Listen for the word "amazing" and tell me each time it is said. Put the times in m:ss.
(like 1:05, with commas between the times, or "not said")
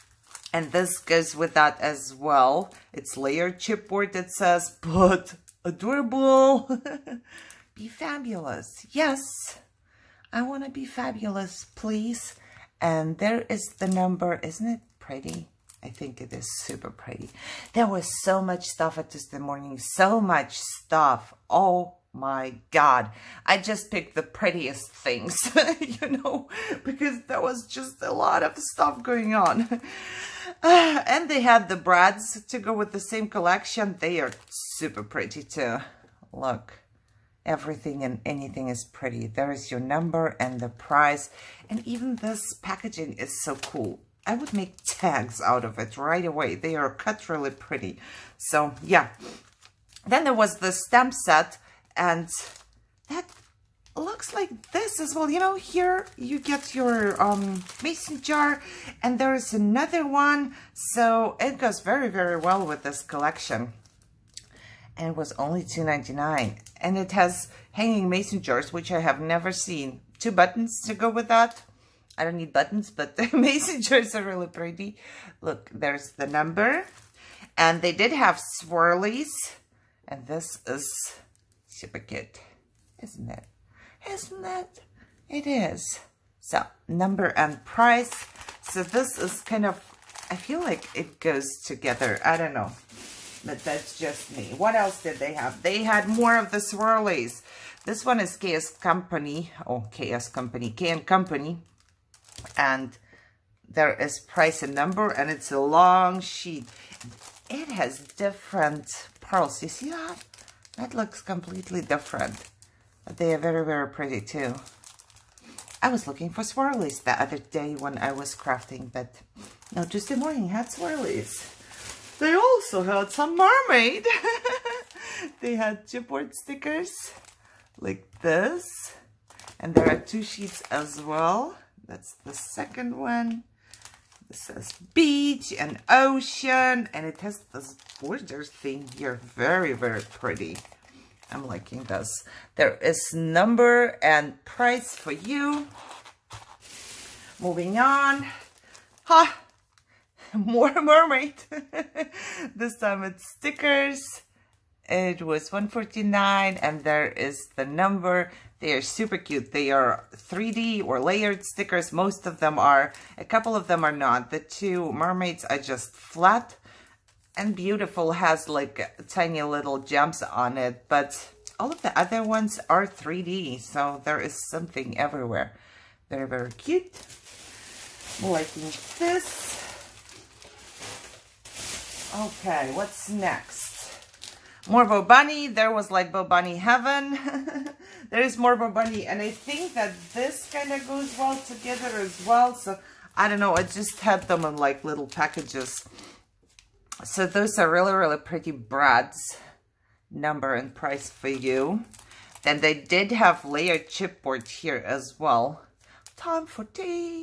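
1:13.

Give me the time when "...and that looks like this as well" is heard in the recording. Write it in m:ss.
0:51.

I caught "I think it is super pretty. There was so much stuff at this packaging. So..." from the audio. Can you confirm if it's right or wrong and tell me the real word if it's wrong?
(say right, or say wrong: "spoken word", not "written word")
wrong: "morning", not "packaging".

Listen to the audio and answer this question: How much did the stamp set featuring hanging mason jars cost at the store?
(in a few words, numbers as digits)
$2.99.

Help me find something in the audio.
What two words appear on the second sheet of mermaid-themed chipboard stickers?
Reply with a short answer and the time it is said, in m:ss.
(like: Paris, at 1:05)
beach and ocean, at 2:14.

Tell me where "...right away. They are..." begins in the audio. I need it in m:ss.
0:45.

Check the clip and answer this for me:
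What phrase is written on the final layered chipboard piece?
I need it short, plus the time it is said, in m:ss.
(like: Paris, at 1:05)
Time for tea, at 3:26.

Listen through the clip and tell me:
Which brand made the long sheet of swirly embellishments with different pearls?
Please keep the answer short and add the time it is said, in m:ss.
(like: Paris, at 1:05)
K and Company, at 1:40.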